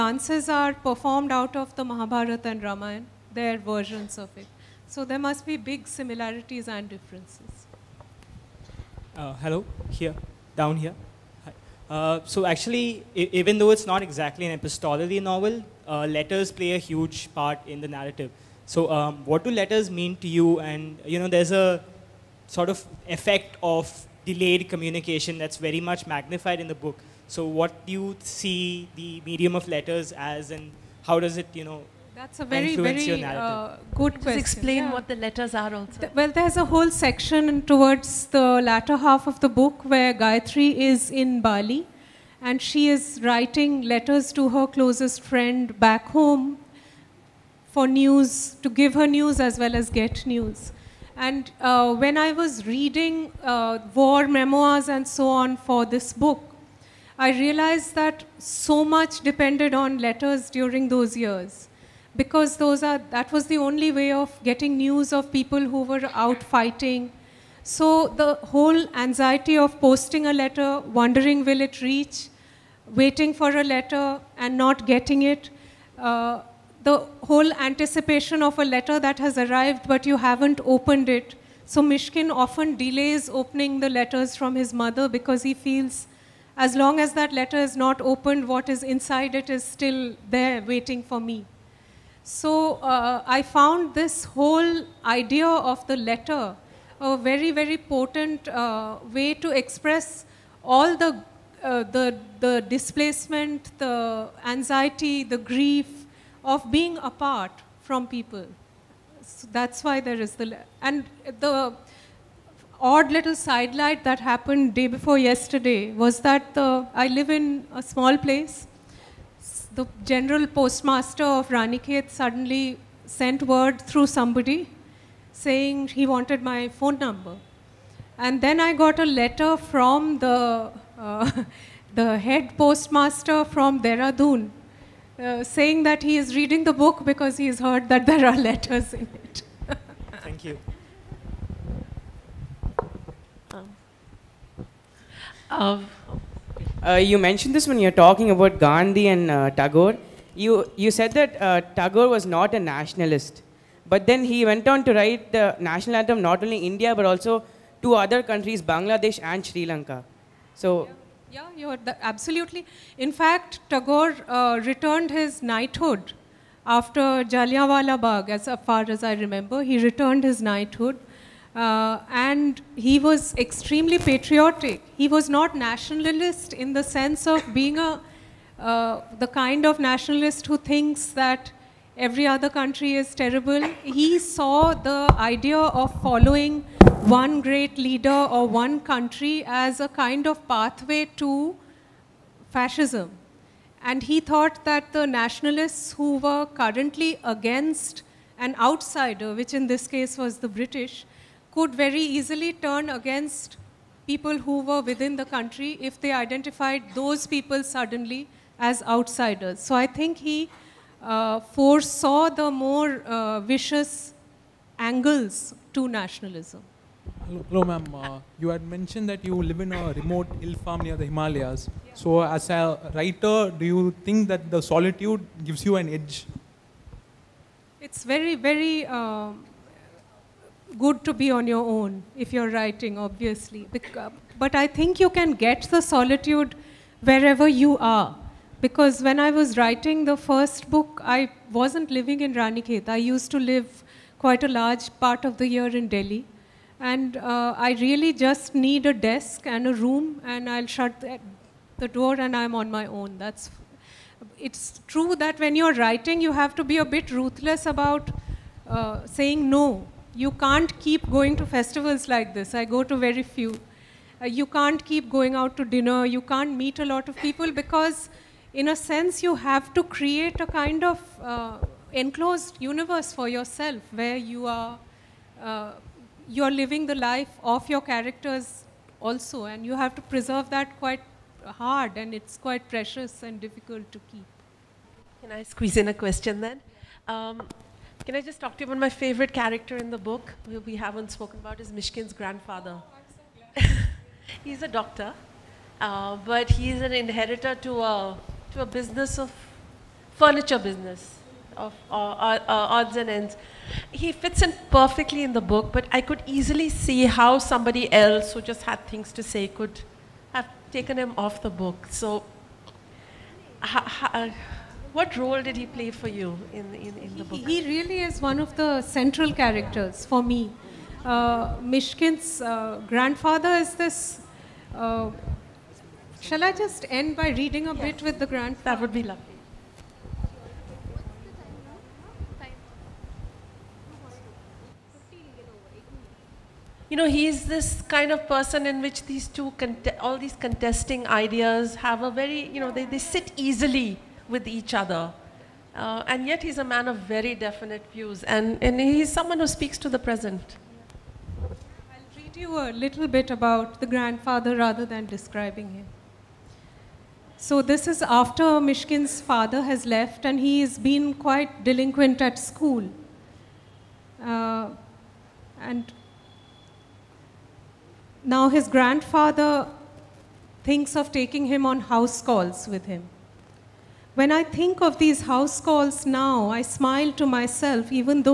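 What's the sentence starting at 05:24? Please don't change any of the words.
Uh, shall I just end by reading a yes.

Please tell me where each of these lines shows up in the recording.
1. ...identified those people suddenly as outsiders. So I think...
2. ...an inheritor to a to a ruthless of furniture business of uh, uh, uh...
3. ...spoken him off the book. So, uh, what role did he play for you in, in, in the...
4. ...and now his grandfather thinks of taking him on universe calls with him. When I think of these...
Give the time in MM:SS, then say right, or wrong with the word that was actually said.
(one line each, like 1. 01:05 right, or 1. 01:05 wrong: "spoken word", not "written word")
1. 03:26 right
2. 04:56 wrong: "business", not "ruthless"
3. 05:10 wrong: "taken", not "spoken"
4. 06:05 wrong: "house", not "universe".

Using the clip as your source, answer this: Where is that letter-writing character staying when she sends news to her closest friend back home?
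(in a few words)
Bali.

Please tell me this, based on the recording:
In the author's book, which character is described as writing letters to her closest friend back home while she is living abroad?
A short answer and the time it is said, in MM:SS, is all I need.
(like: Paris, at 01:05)
Gayatri, at 00:40.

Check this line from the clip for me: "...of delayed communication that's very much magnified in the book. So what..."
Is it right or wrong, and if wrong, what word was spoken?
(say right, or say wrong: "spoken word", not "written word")
right.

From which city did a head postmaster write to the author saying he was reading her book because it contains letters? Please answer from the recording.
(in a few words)
Dehradun.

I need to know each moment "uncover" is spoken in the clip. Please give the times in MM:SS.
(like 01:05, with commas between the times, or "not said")
not said.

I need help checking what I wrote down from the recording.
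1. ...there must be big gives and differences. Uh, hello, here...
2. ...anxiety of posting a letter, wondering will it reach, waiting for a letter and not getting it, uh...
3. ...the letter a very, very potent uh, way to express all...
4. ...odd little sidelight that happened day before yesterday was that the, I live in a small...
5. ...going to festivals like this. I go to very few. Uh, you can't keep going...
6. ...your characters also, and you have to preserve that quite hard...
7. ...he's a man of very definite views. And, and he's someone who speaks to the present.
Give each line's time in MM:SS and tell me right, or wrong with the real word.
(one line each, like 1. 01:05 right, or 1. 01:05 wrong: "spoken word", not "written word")
1. 00:05 wrong: "similarities", not "gives"
2. 01:08 right
3. 01:35 right
4. 01:52 right
5. 04:21 right
6. 04:37 right
7. 05:46 right.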